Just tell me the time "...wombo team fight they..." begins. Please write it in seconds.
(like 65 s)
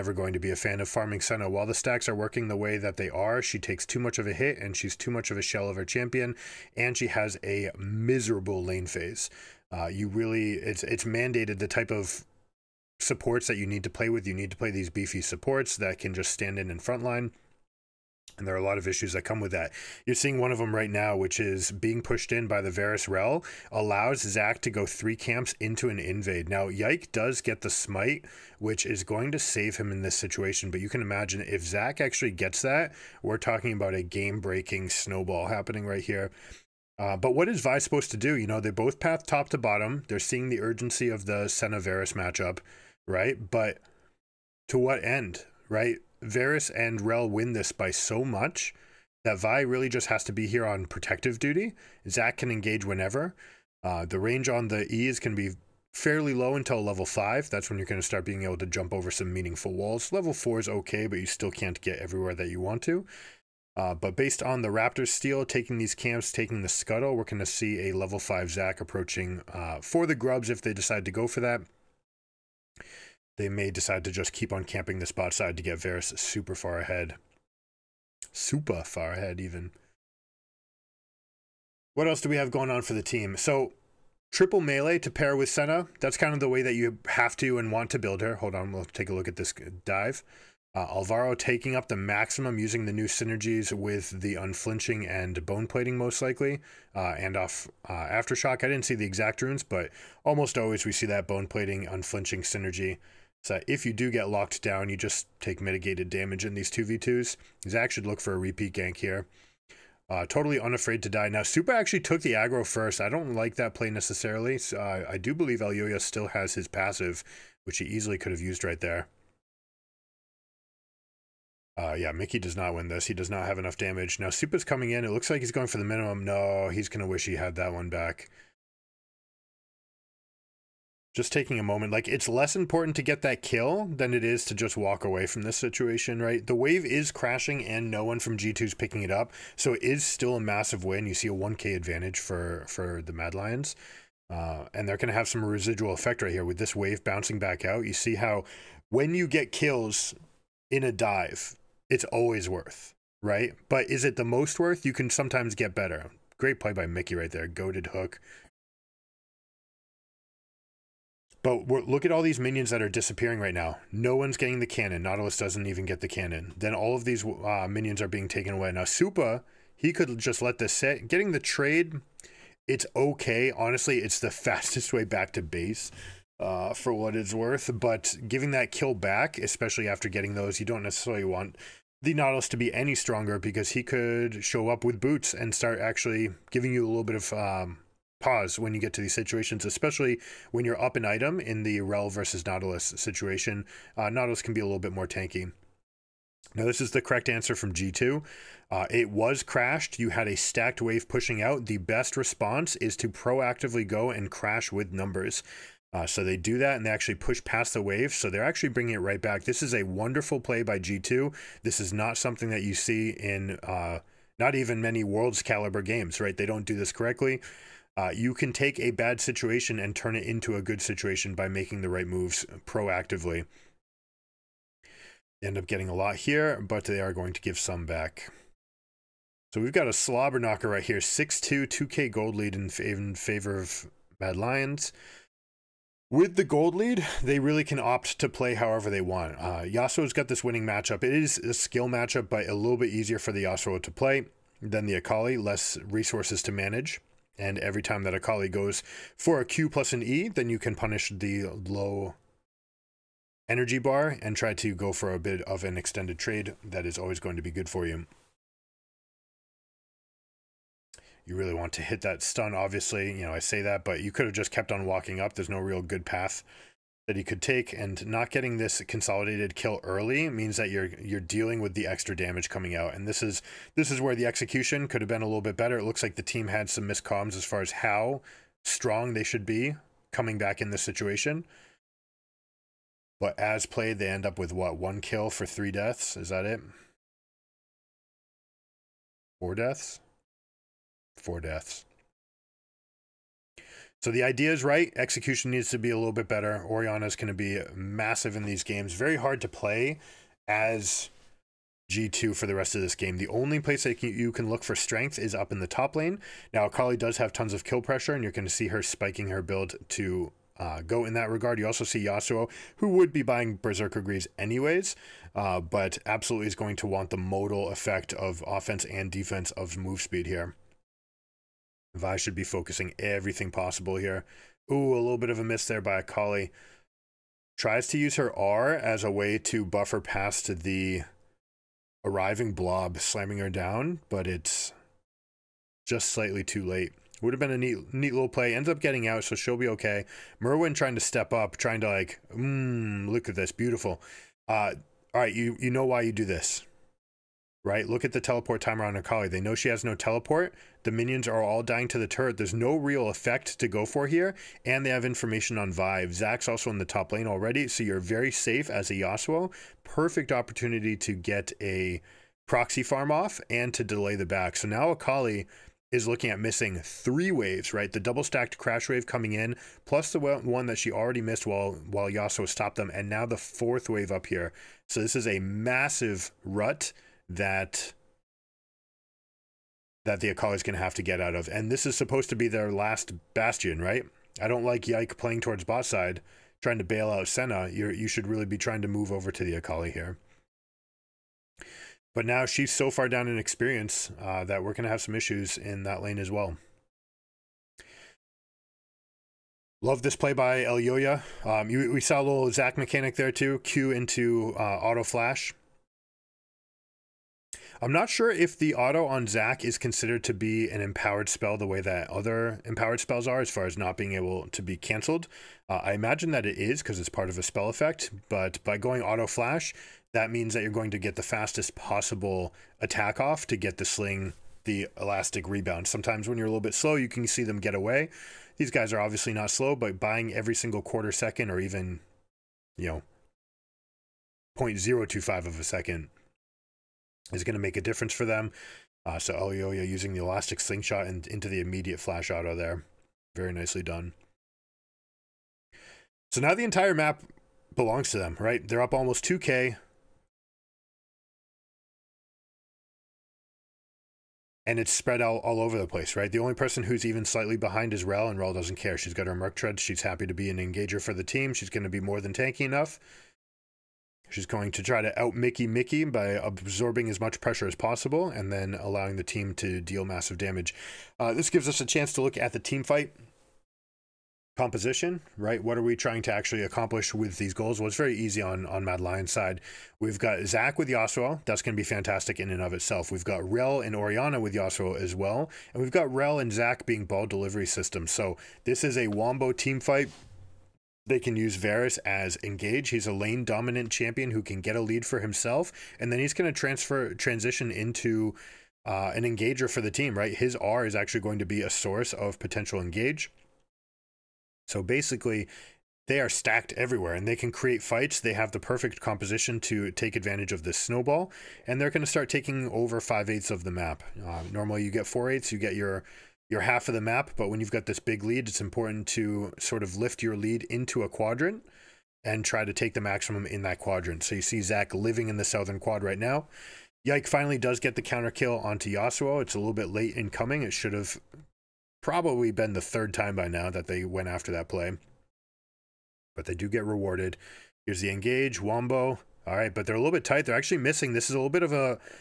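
489 s.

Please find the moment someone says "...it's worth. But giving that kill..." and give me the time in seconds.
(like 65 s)
177 s.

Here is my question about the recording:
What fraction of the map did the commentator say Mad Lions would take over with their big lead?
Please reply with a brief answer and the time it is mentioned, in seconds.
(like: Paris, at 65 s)
five eighths, at 512 s.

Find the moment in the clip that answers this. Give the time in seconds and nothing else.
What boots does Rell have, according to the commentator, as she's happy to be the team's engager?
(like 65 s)
459 s.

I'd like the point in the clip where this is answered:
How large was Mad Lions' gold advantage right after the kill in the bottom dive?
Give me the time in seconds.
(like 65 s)
141 s.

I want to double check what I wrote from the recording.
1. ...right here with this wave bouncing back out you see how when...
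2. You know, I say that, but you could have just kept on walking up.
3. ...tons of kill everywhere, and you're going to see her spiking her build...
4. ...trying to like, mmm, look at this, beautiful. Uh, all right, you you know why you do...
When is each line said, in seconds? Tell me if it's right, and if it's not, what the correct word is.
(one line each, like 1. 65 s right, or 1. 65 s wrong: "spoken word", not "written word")
1. 146 s right
2. 263 s right
3. 307 s wrong: "pressure", not "everywhere"
4. 341 s right.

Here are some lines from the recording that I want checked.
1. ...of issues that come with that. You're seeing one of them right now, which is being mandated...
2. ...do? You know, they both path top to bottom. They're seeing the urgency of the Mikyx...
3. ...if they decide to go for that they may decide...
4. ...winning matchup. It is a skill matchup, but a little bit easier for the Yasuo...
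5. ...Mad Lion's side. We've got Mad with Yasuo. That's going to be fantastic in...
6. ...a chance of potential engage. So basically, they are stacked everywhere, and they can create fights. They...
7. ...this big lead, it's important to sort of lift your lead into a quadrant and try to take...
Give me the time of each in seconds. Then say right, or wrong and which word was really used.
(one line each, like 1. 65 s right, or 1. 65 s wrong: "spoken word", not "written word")
1. 18 s wrong: "pushed", not "mandated"
2. 38 s wrong: "Senna", not "Mikyx"
3. 70 s right
4. 240 s right
5. 478 s wrong: "Zac", not "Mad"
6. 501 s wrong: "source", not "chance"
7. 517 s right.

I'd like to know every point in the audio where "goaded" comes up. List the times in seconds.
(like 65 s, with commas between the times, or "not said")
157 s.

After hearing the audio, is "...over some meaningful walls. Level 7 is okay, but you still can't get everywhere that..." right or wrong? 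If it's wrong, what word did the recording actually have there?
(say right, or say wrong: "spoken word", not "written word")
wrong: "4", not "7".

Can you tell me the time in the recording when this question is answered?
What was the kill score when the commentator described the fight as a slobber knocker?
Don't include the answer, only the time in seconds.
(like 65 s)
230 s.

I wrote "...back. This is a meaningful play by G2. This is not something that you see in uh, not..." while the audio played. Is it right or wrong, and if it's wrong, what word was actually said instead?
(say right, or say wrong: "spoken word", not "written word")
wrong: "wonderful", not "meaningful".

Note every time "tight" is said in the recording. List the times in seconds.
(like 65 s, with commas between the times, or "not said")
540 s.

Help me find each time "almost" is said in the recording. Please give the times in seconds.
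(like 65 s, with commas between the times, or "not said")
100 s, 448 s.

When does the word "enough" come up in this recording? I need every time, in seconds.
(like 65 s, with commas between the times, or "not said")
123 s, 462 s.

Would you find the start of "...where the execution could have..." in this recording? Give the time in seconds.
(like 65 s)
273 s.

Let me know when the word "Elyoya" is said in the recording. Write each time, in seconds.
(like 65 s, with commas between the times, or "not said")
115 s, 400 s.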